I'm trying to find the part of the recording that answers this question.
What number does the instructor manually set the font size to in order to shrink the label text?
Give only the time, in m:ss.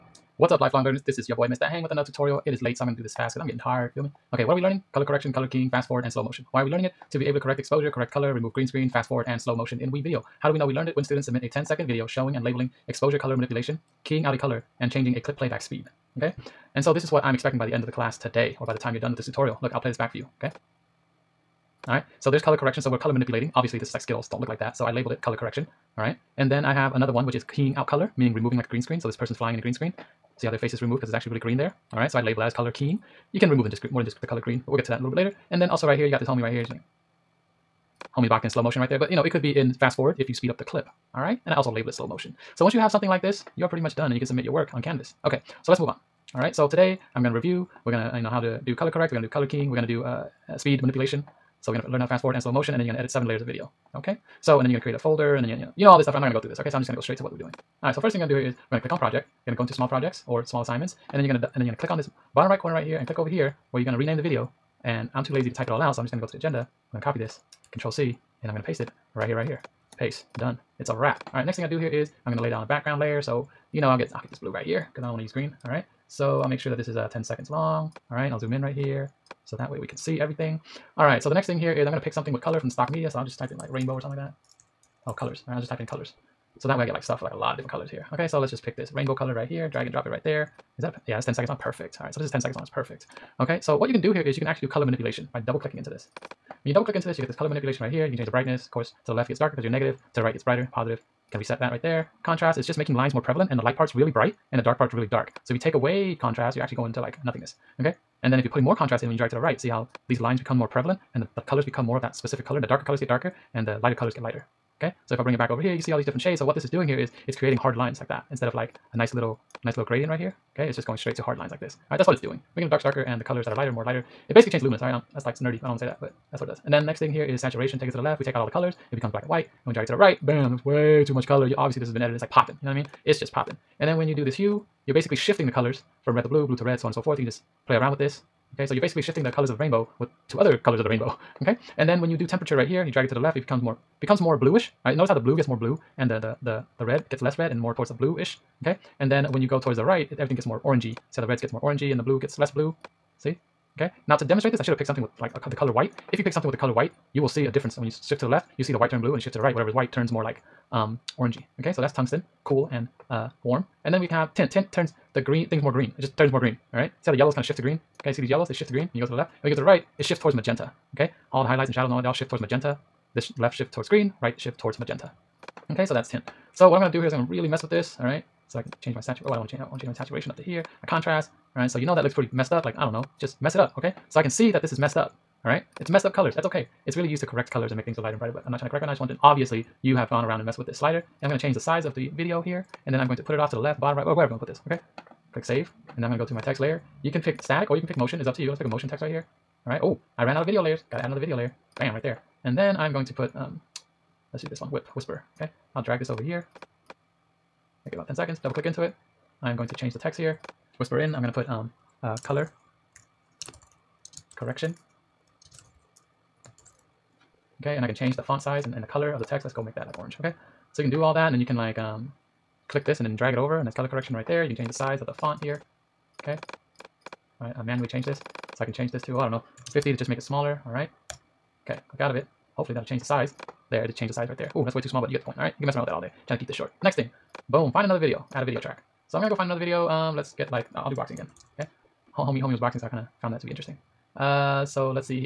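3:49.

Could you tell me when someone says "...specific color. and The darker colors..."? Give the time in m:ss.
1:52.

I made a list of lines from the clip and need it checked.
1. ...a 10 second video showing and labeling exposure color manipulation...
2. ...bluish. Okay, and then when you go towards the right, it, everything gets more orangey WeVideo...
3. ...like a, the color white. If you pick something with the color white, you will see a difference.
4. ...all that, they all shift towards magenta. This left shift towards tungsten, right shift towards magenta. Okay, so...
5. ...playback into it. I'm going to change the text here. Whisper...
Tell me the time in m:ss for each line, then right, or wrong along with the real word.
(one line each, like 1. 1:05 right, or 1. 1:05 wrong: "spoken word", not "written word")
1. 0:11 right
2. 2:27 wrong: "See", not "WeVideo"
3. 2:35 right
4. 2:51 wrong: "green", not "tungsten"
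5. 3:28 wrong: "click", not "playback".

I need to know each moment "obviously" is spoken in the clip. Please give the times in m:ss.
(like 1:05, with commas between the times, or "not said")
0:23, 2:11, 3:09.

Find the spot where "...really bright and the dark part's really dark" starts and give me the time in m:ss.
1:43.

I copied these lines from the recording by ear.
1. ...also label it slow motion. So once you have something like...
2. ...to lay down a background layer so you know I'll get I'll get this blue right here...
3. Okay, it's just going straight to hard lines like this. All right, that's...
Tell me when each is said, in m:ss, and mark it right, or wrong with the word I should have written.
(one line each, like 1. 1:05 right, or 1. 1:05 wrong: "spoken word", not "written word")
1. 0:41 right
2. 1:12 right
3. 2:00 right.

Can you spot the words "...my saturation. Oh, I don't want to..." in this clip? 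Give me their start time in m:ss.
2:58.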